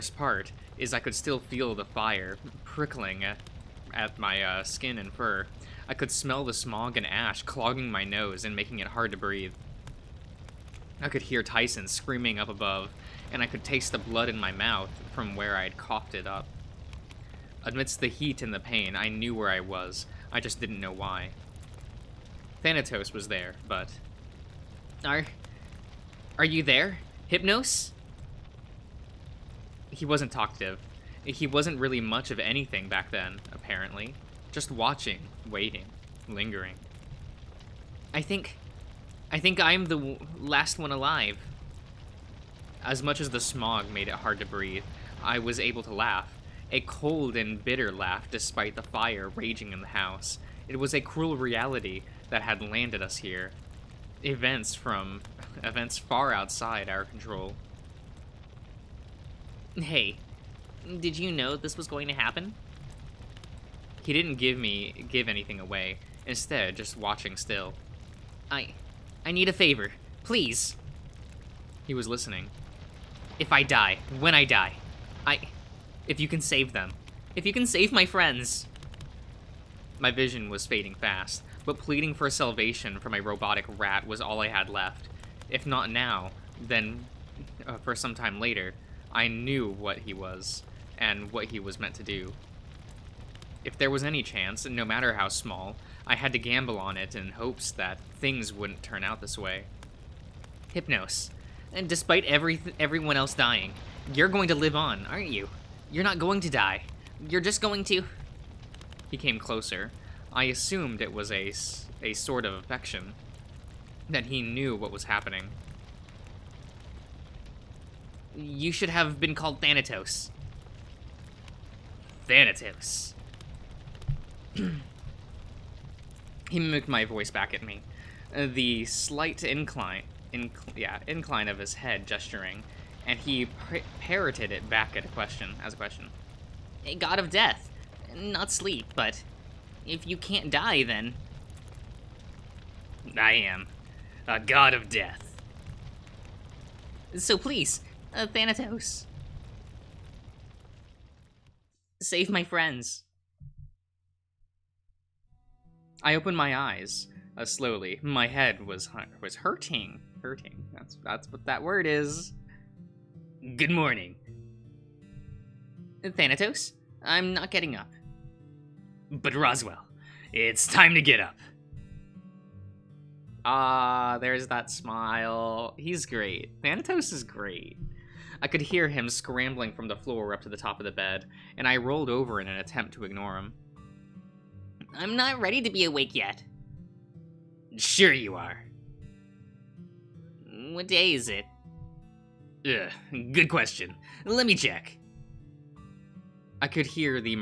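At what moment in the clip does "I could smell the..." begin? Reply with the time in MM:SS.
00:05.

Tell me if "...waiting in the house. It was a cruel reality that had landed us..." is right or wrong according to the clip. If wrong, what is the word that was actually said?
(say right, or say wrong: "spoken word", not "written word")
wrong: "raging", not "waiting".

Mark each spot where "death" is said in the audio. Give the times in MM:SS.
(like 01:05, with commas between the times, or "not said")
02:17, 02:24.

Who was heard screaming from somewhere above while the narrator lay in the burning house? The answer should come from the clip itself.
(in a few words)
Tyson.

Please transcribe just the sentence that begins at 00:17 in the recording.
Amidst the heat and the pain, I knew where I was.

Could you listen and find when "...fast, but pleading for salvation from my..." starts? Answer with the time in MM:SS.
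01:20.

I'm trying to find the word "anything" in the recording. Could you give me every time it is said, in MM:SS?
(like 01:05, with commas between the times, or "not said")
00:32, 01:05.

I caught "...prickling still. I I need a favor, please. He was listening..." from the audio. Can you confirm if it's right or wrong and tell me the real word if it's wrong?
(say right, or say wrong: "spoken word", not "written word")
wrong: "watching", not "prickling".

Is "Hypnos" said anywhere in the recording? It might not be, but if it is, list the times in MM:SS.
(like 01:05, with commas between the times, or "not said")
00:27, 01:40.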